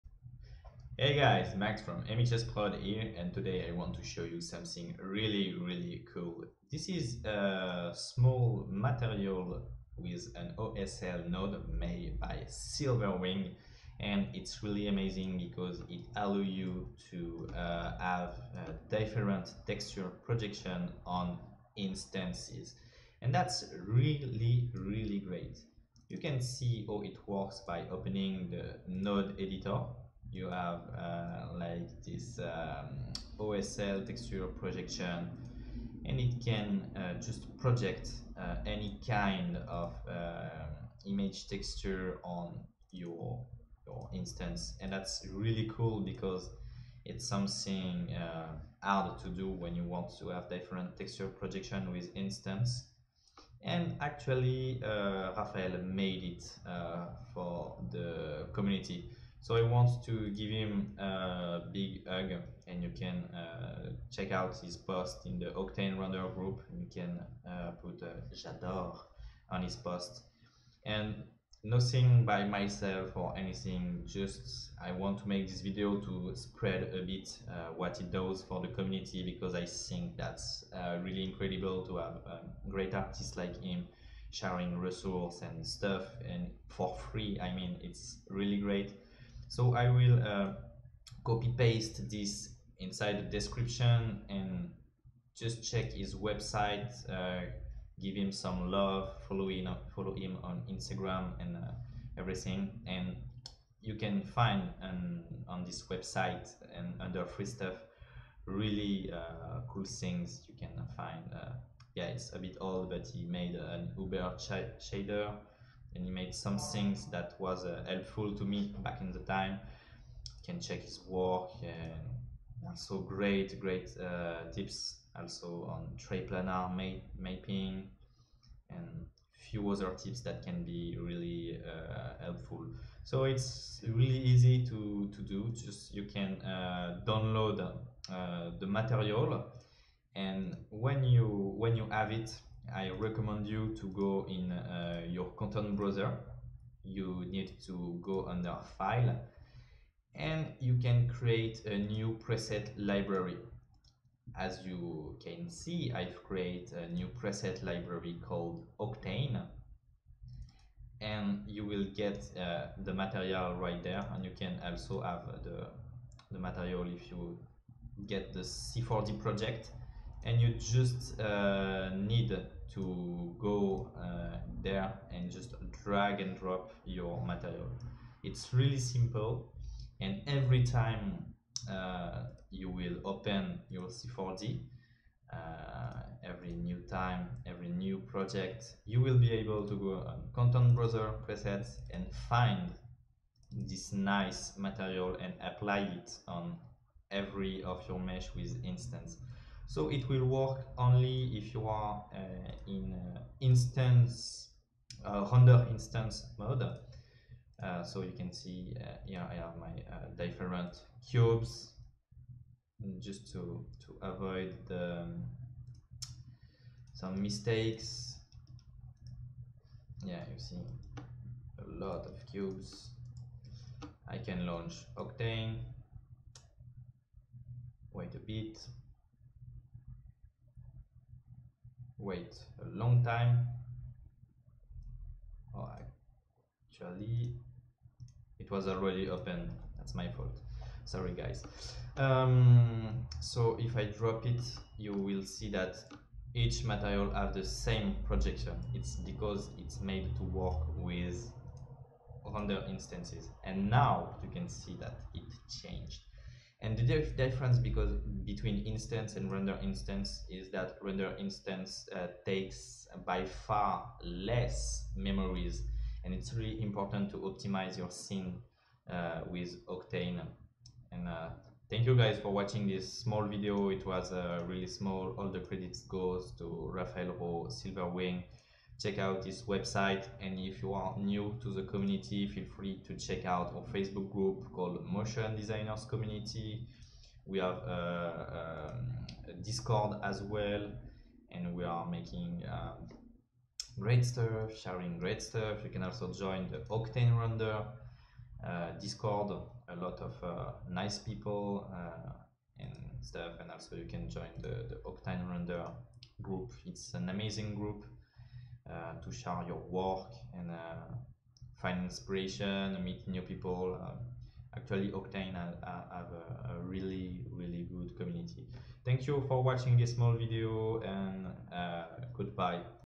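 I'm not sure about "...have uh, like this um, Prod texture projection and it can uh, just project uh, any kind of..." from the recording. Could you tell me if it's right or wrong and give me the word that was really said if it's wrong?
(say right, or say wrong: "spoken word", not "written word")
wrong: "OSL", not "Prod".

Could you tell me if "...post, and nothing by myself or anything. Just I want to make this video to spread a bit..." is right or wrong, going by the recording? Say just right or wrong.
right.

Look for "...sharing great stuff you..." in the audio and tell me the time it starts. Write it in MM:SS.
04:54.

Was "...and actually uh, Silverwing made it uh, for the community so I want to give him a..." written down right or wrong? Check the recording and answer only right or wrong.
wrong.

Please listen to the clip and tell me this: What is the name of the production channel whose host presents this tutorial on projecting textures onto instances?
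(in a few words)
MXS Prod.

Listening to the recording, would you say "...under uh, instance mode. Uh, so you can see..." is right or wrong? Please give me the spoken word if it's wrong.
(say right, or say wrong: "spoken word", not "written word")
wrong: "render", not "under".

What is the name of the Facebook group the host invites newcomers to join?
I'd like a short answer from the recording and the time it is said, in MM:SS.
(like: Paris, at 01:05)
motion designers community, at 04:44.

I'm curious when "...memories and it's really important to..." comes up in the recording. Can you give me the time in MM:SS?
04:24.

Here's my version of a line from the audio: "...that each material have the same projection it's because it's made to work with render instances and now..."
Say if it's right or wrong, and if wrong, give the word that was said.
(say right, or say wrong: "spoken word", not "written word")
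right.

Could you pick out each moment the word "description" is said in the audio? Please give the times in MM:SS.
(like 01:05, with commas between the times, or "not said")
01:33.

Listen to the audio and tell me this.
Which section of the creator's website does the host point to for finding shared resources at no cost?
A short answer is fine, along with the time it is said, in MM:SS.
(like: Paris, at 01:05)
free stuff, at 01:47.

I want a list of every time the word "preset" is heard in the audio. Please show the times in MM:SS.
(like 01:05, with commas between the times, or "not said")
02:32, 02:37, 03:11.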